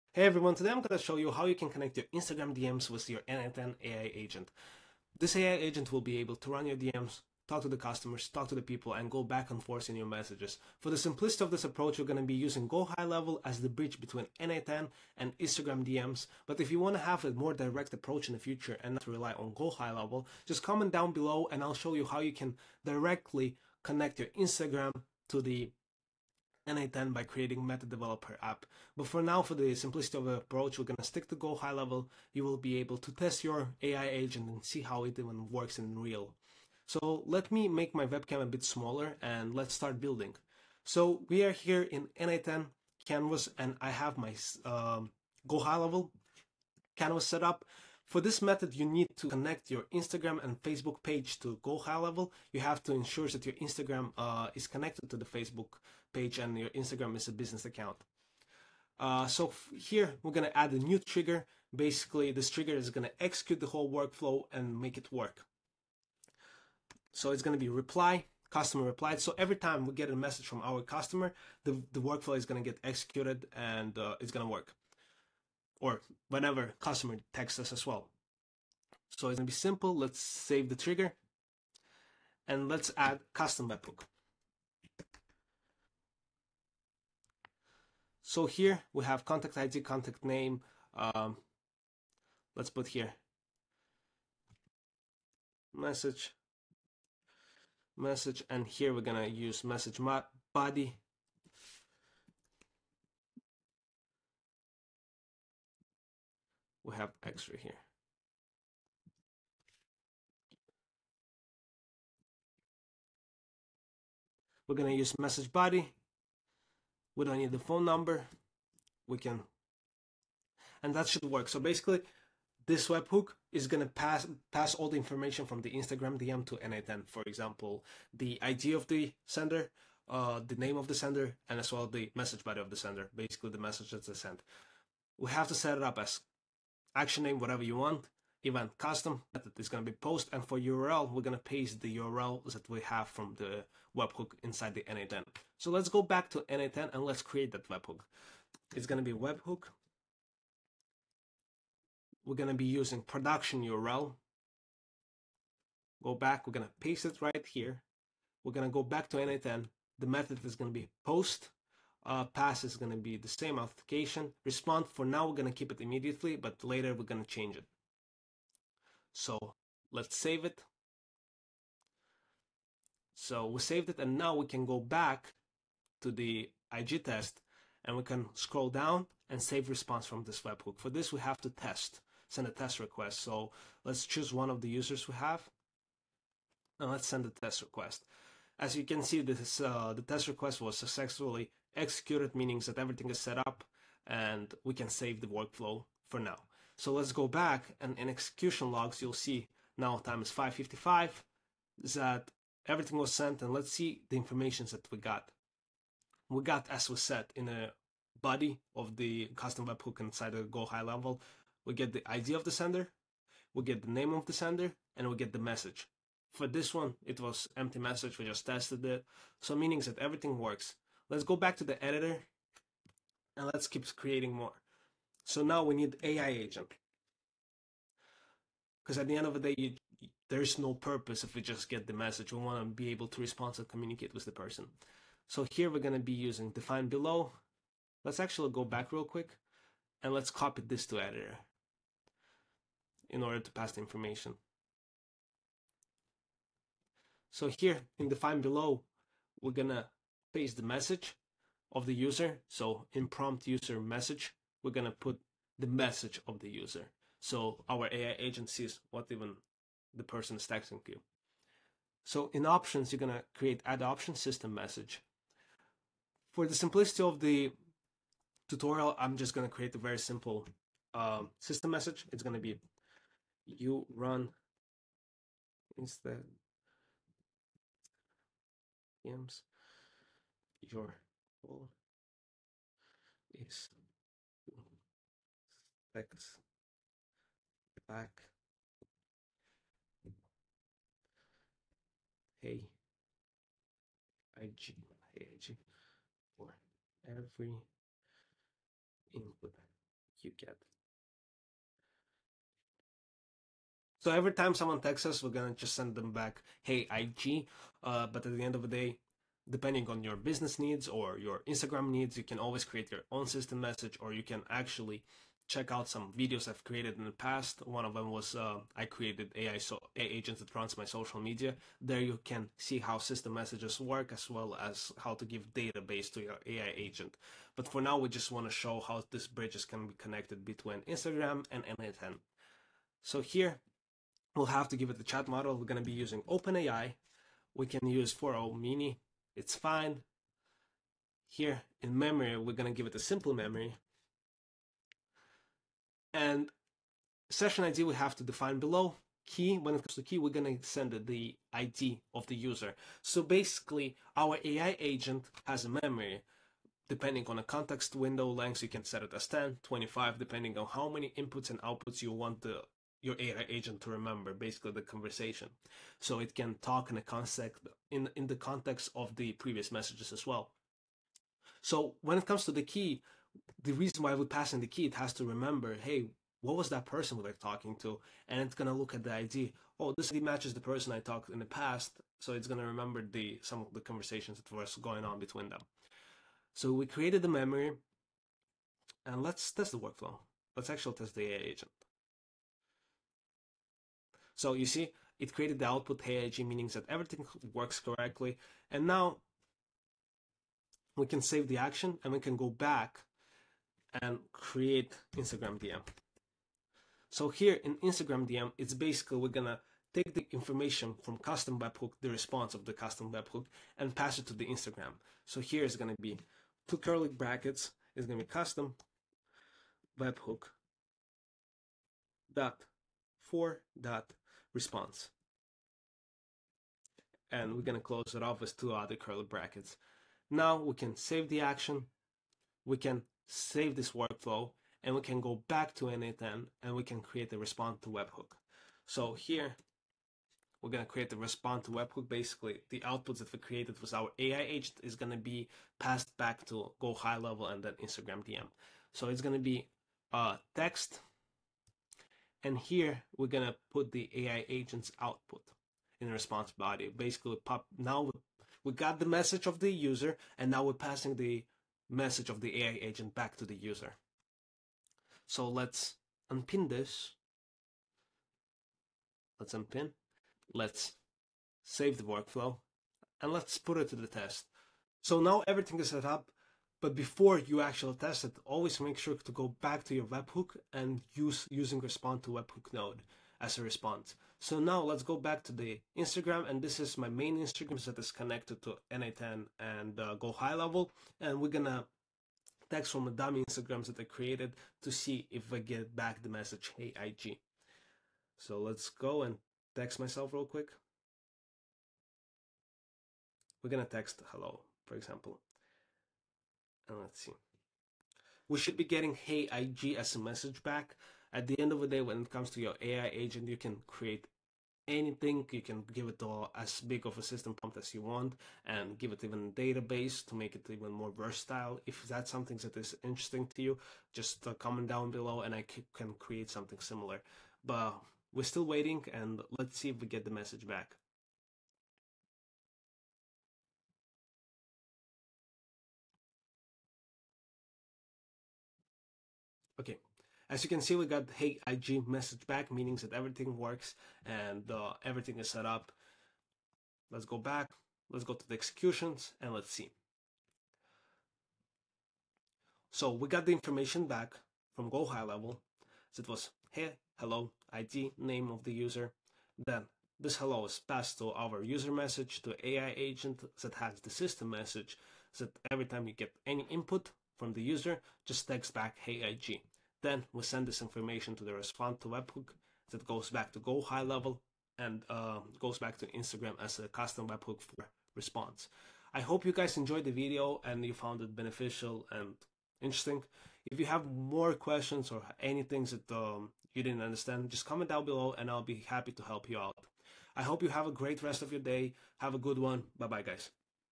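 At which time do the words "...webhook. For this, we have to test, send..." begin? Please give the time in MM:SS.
03:00.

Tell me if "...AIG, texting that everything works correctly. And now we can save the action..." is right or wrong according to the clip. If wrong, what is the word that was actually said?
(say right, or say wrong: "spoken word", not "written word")
wrong: "meaning", not "texting".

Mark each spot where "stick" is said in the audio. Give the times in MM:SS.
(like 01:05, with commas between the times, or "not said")
00:31.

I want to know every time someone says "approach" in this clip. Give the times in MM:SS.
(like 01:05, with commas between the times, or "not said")
00:11, 00:17, 00:30.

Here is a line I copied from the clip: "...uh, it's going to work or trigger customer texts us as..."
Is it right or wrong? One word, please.
wrong.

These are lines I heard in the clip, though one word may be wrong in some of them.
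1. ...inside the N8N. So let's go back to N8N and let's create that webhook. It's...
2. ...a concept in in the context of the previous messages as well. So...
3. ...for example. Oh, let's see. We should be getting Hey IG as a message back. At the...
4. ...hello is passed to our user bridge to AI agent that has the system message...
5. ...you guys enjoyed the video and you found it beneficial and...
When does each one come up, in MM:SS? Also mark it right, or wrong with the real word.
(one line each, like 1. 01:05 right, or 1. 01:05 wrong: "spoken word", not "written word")
1. 02:24 right
2. 06:06 right
3. 08:24 right
4. 09:20 wrong: "message", not "bridge"
5. 09:39 right.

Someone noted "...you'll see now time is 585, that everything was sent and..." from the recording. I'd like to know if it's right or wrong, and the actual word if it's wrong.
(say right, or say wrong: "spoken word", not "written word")
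wrong: "555", not "585".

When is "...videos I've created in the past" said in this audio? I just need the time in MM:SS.
05:16.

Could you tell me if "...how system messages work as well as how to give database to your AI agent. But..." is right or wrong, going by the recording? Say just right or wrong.
right.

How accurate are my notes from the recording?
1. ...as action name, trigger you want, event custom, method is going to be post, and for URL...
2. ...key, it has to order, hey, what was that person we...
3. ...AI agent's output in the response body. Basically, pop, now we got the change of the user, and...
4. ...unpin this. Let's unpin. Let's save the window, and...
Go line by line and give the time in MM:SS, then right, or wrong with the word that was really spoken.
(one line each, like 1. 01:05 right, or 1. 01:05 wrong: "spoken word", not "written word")
1. 02:15 wrong: "whatever", not "trigger"
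2. 06:14 wrong: "remember", not "order"
3. 07:34 wrong: "message", not "change"
4. 07:46 wrong: "workflow", not "window".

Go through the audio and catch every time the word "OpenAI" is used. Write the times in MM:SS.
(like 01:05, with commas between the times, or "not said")
05:36.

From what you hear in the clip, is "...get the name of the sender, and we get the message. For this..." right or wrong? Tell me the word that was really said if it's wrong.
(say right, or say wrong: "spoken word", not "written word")
right.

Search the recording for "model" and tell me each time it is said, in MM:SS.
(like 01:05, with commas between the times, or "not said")
05:35.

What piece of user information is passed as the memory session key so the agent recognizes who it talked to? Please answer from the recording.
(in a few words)
ID of the user.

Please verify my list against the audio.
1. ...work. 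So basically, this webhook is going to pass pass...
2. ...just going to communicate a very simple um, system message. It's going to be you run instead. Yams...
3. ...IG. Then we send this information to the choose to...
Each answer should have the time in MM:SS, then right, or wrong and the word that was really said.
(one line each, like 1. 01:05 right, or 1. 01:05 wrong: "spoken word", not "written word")
1. 02:01 right
2. 04:29 wrong: "create", not "communicate"
3. 09:29 wrong: "response", not "choose".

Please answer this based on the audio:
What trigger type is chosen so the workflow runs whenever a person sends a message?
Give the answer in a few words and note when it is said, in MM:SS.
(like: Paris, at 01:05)
customer replied, at 01:08.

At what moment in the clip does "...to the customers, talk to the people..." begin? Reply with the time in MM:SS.
00:07.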